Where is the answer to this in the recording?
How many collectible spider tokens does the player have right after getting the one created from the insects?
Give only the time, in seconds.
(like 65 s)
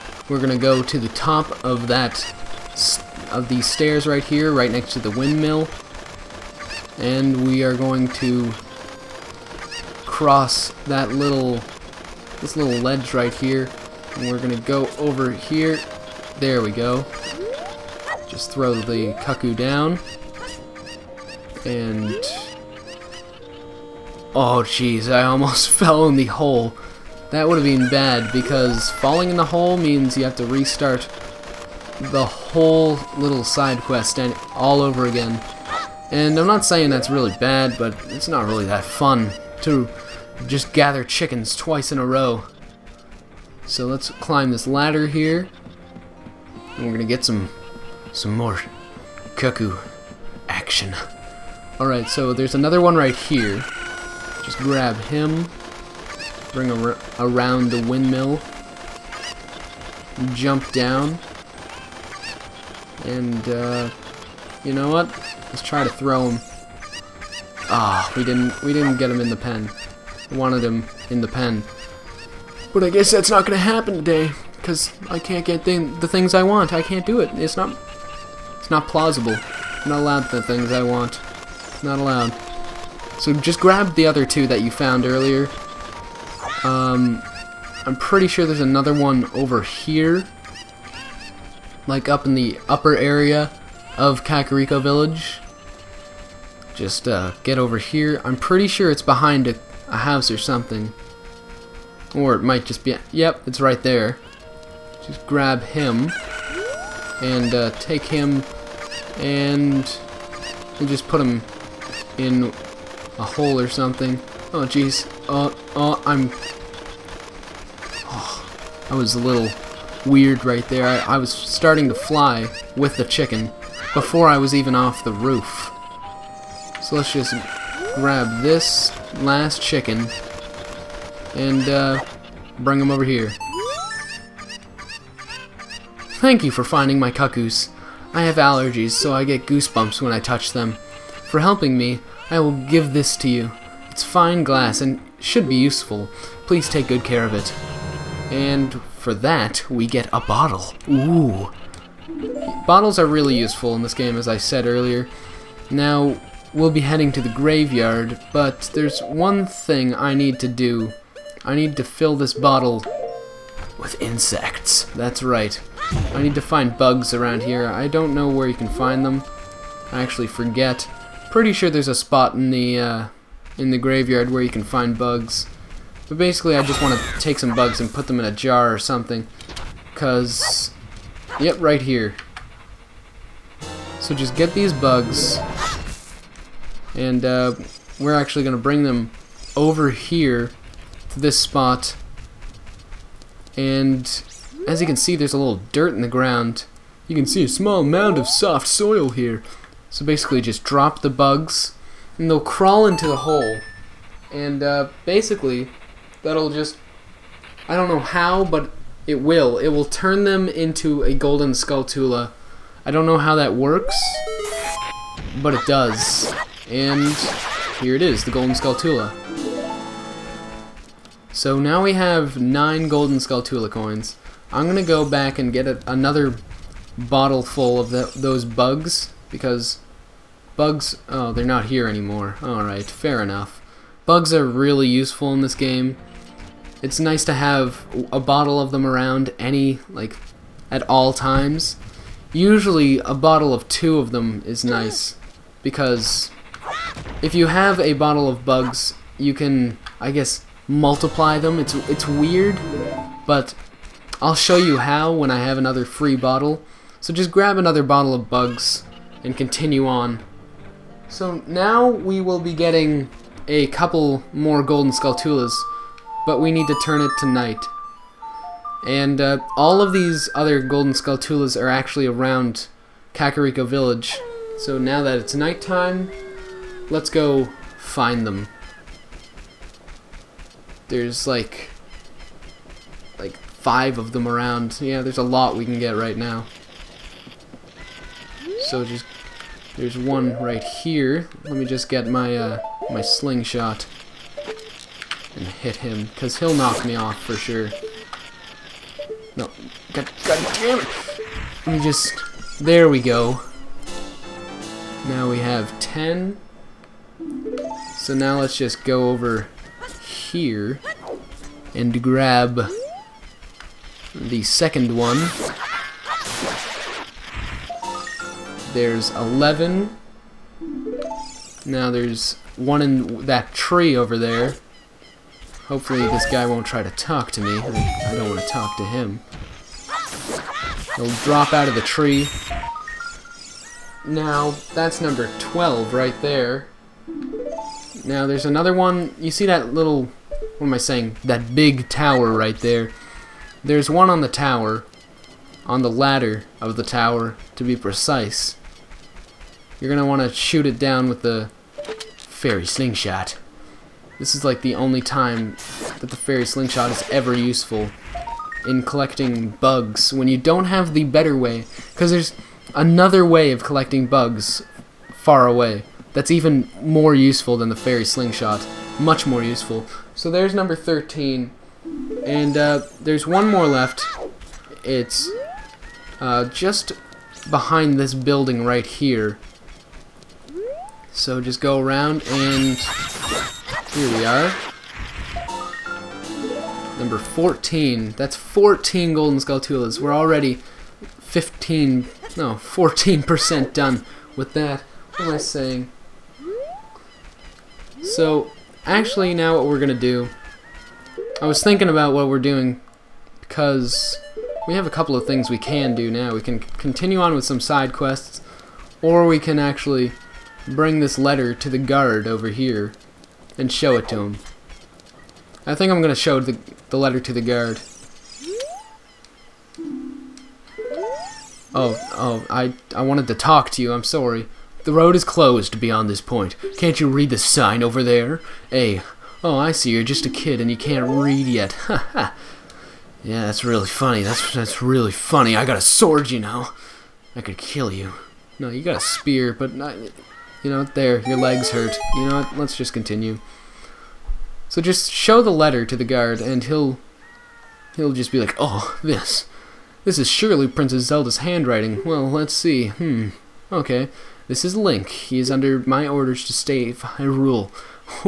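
222 s.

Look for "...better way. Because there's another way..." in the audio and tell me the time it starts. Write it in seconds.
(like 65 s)
361 s.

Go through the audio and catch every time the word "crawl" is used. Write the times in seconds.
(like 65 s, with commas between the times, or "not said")
202 s.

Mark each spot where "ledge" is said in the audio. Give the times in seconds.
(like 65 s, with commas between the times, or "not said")
12 s.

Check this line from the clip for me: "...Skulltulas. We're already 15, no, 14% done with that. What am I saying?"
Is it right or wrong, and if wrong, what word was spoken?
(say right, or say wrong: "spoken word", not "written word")
right.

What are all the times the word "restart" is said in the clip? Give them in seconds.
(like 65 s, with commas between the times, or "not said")
30 s.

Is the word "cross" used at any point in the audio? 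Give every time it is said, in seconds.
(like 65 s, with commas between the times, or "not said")
10 s.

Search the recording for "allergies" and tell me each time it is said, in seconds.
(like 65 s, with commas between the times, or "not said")
138 s.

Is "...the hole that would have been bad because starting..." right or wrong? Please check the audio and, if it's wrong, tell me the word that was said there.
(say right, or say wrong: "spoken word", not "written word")
wrong: "falling", not "starting".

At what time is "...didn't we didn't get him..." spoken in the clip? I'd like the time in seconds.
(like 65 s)
68 s.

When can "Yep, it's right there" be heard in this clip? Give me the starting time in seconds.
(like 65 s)
103 s.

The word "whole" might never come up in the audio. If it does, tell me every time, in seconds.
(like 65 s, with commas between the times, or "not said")
32 s.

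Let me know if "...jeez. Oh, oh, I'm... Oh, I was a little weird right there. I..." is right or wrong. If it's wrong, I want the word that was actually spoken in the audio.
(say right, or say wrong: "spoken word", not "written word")
right.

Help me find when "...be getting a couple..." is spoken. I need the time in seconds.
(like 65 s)
262 s.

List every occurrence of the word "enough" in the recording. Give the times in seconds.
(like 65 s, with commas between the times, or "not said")
233 s.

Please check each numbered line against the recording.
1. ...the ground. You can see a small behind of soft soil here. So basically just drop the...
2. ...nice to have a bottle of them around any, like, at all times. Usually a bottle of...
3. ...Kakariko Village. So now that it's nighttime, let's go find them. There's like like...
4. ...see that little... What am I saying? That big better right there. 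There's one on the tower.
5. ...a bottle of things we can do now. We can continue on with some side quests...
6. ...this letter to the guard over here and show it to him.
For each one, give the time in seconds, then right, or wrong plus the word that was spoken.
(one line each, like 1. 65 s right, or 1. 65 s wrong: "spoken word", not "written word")
1. 196 s wrong: "mound", not "behind"
2. 236 s right
3. 273 s right
4. 339 s wrong: "tower", not "better"
5. 404 s wrong: "couple", not "bottle"
6. 410 s right.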